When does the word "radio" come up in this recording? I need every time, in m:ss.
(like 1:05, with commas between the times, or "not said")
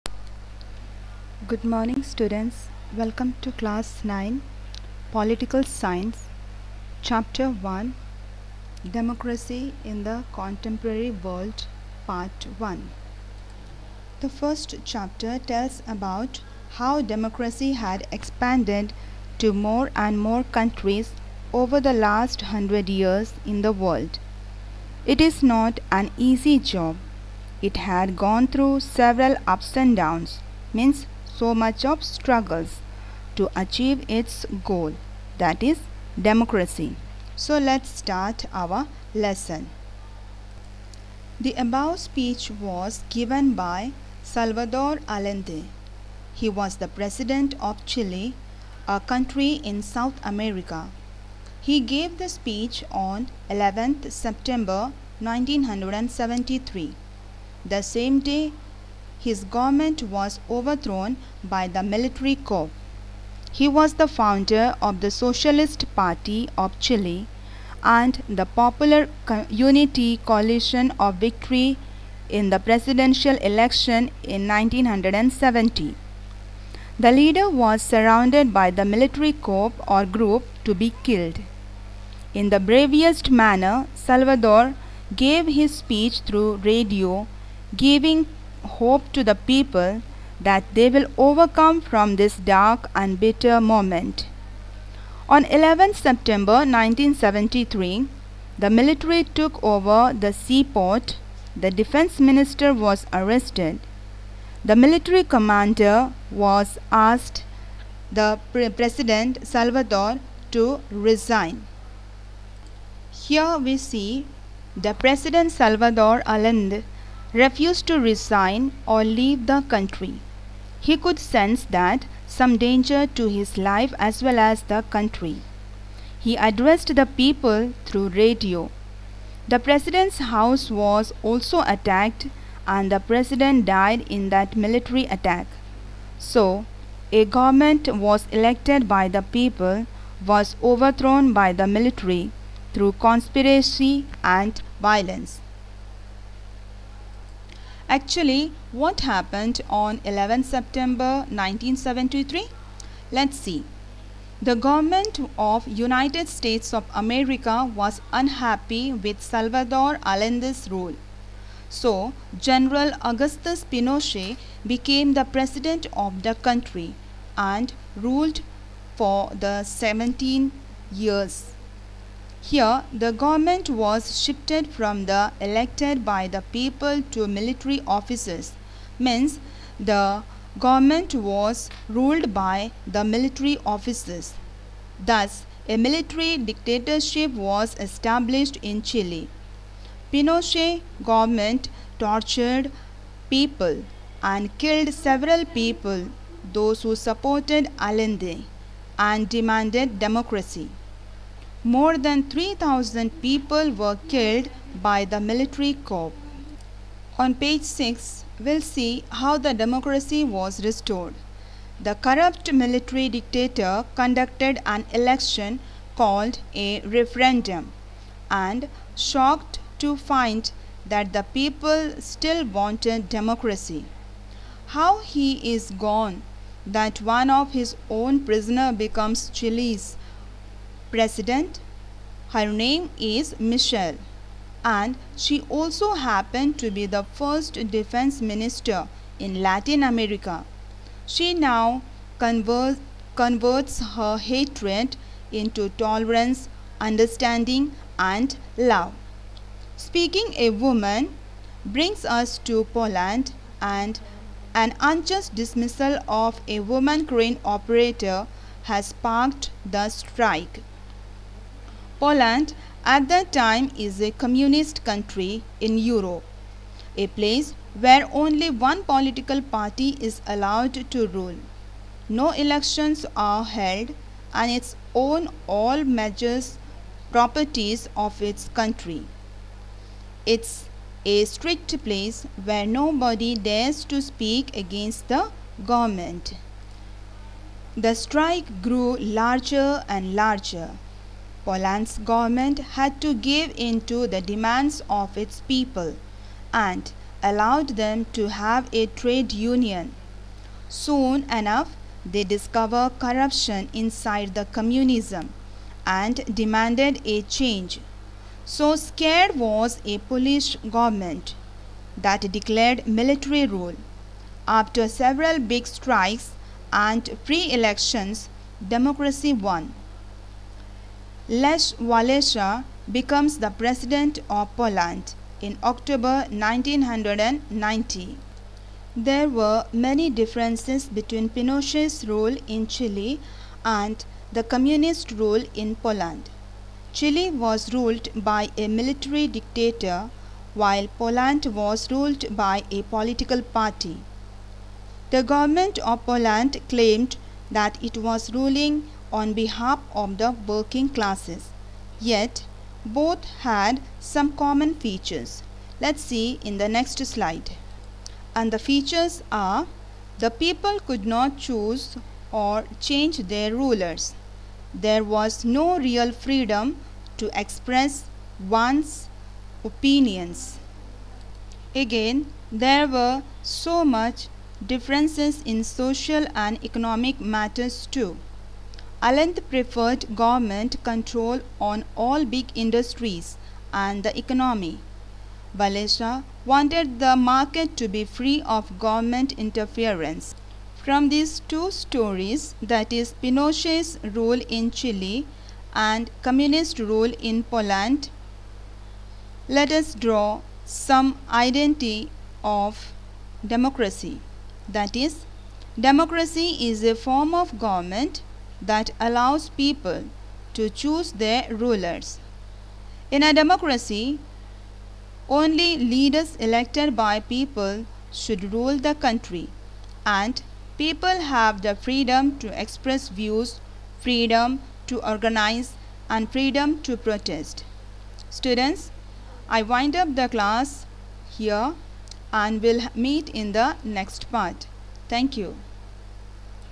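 1:26, 2:08.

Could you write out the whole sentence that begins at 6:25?
Walesa wanted the market to be free of government interference.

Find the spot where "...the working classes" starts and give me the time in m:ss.
5:50.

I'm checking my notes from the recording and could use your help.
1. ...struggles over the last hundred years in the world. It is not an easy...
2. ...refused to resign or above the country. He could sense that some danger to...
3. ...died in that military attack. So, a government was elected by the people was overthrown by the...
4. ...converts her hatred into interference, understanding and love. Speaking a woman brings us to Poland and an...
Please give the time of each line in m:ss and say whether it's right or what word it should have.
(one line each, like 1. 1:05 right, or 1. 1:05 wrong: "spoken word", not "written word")
1. 0:20 wrong: "countries", not "struggles"
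2. 1:57 wrong: "leave", not "above"
3. 2:13 right
4. 4:03 wrong: "tolerance", not "interference".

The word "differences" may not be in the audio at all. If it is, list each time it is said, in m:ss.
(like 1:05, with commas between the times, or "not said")
5:30, 6:14.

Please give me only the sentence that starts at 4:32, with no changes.
No elections are held and its own all measures properties of its country.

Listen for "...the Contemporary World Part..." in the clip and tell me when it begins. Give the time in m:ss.
0:10.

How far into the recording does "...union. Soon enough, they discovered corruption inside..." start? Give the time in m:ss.
4:59.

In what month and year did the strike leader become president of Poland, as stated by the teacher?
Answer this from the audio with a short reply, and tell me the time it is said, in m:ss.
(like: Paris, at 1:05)
October 1990, at 5:25.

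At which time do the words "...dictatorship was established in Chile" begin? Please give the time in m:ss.
3:06.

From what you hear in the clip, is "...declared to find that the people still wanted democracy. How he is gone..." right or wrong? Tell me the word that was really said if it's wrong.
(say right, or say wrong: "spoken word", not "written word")
wrong: "shocked", not "declared".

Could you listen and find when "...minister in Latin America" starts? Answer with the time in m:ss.
3:58.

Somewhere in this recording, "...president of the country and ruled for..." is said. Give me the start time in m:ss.
2:45.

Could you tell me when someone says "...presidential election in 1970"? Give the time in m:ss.
1:12.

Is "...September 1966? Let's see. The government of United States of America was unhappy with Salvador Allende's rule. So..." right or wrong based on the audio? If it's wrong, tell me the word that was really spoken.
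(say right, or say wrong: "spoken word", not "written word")
wrong: "1973", not "1966".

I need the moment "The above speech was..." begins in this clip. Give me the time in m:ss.
0:41.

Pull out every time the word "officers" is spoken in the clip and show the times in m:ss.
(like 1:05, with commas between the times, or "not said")
2:57, 3:03.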